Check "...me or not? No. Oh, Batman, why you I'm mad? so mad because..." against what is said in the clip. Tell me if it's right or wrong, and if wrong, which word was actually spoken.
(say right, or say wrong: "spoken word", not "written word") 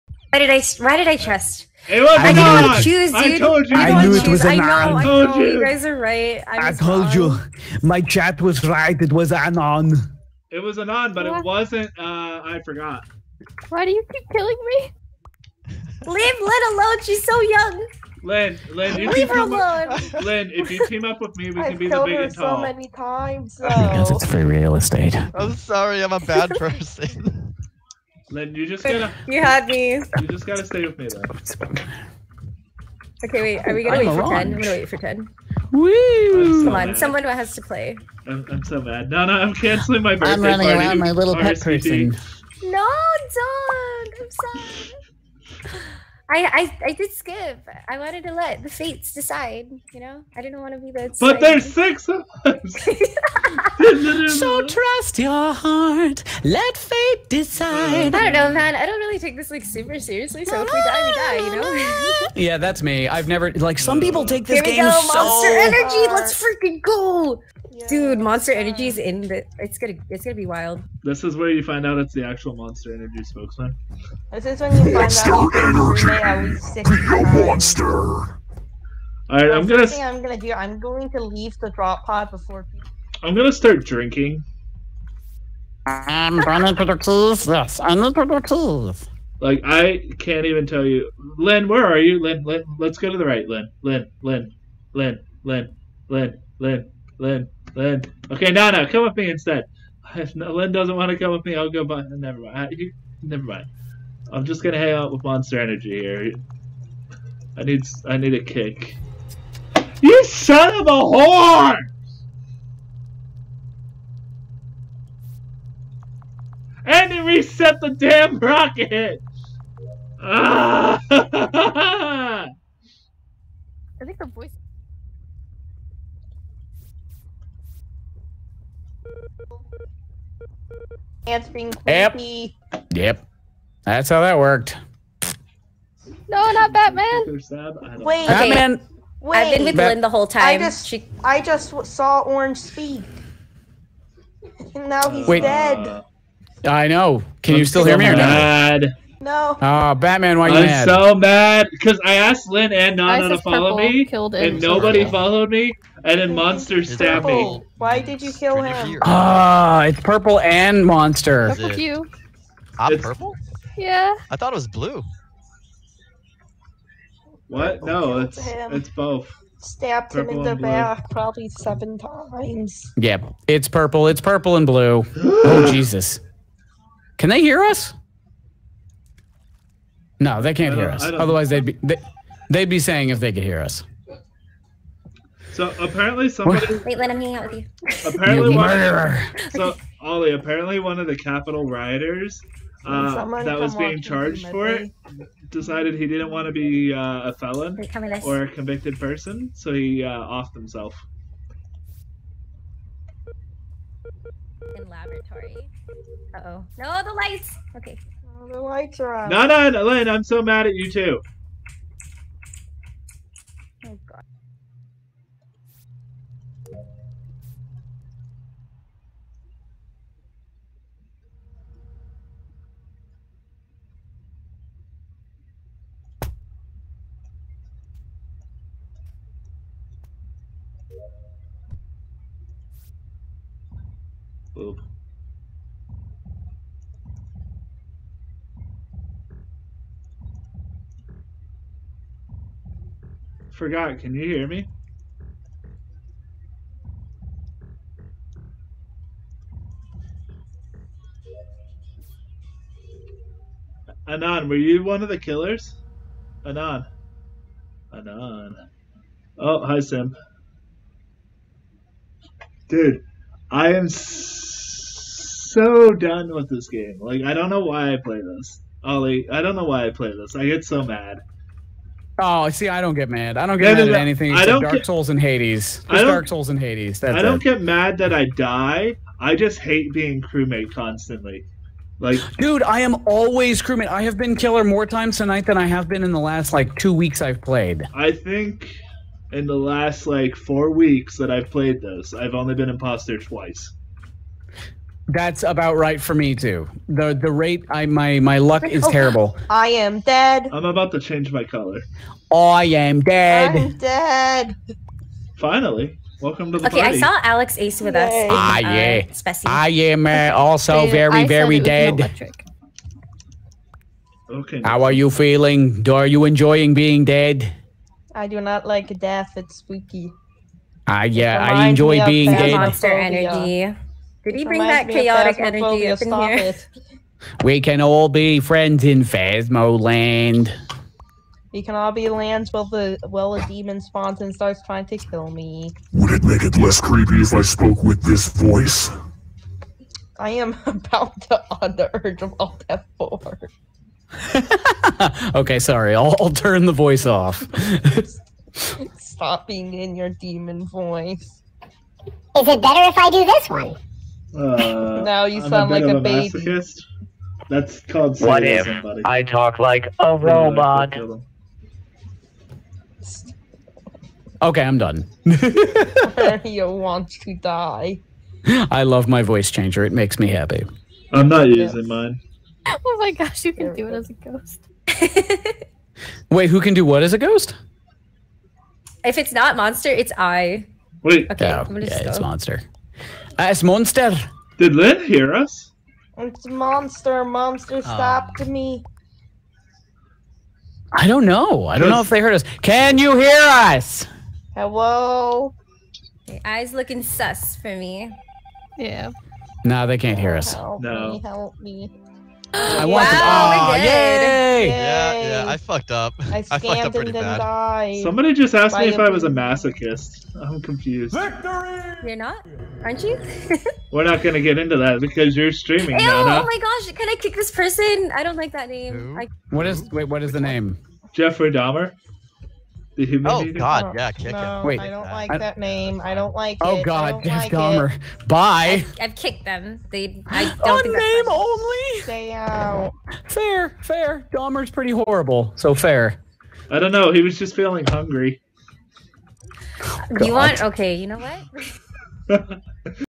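right.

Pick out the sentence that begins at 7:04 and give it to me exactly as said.
Wait, I don't like I, that name.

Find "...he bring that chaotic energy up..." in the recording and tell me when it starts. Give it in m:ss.
5:24.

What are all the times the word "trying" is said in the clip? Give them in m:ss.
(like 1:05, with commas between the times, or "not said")
5:34.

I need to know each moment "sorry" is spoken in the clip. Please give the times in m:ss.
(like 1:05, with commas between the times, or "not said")
0:25, 0:44, 5:45.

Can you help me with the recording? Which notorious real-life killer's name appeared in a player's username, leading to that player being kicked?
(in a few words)
Jeffrey Dahmer.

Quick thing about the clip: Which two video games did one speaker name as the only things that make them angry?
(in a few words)
Dark Souls and Hades.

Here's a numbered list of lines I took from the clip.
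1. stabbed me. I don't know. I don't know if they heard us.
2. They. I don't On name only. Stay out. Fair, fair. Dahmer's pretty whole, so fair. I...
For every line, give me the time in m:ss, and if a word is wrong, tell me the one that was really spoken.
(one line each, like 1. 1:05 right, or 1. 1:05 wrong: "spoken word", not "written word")
1. 6:27 wrong: "stopped", not "stabbed"
2. 7:09 wrong: "horrible", not "whole".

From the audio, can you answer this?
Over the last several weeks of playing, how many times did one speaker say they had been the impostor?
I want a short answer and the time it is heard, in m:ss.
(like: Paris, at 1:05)
2, at 4:53.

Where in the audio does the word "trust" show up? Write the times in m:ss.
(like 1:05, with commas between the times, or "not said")
0:01, 0:54.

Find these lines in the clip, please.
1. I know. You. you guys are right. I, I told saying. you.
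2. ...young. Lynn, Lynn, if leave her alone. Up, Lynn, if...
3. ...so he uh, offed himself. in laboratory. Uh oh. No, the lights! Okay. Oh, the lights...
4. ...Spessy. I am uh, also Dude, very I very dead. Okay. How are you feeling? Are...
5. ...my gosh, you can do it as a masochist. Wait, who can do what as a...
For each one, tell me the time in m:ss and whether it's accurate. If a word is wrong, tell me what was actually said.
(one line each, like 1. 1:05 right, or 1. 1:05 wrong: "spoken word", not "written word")
1. 0:04 wrong: "wrong", not "saying"
2. 0:17 right
3. 3:19 right
4. 5:09 right
5. 6:12 wrong: "ghost", not "masochist".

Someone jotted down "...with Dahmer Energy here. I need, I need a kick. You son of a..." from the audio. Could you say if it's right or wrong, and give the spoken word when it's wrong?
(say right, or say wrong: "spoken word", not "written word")
wrong: "Monster", not "Dahmer".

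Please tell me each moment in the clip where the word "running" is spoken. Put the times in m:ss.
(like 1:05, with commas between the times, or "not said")
0:40, 1:26.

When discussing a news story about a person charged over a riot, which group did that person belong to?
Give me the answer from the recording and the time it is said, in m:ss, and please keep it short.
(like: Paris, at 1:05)
Capitol rioters, at 3:11.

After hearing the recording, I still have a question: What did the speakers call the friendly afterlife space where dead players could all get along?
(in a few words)
Phasmoland.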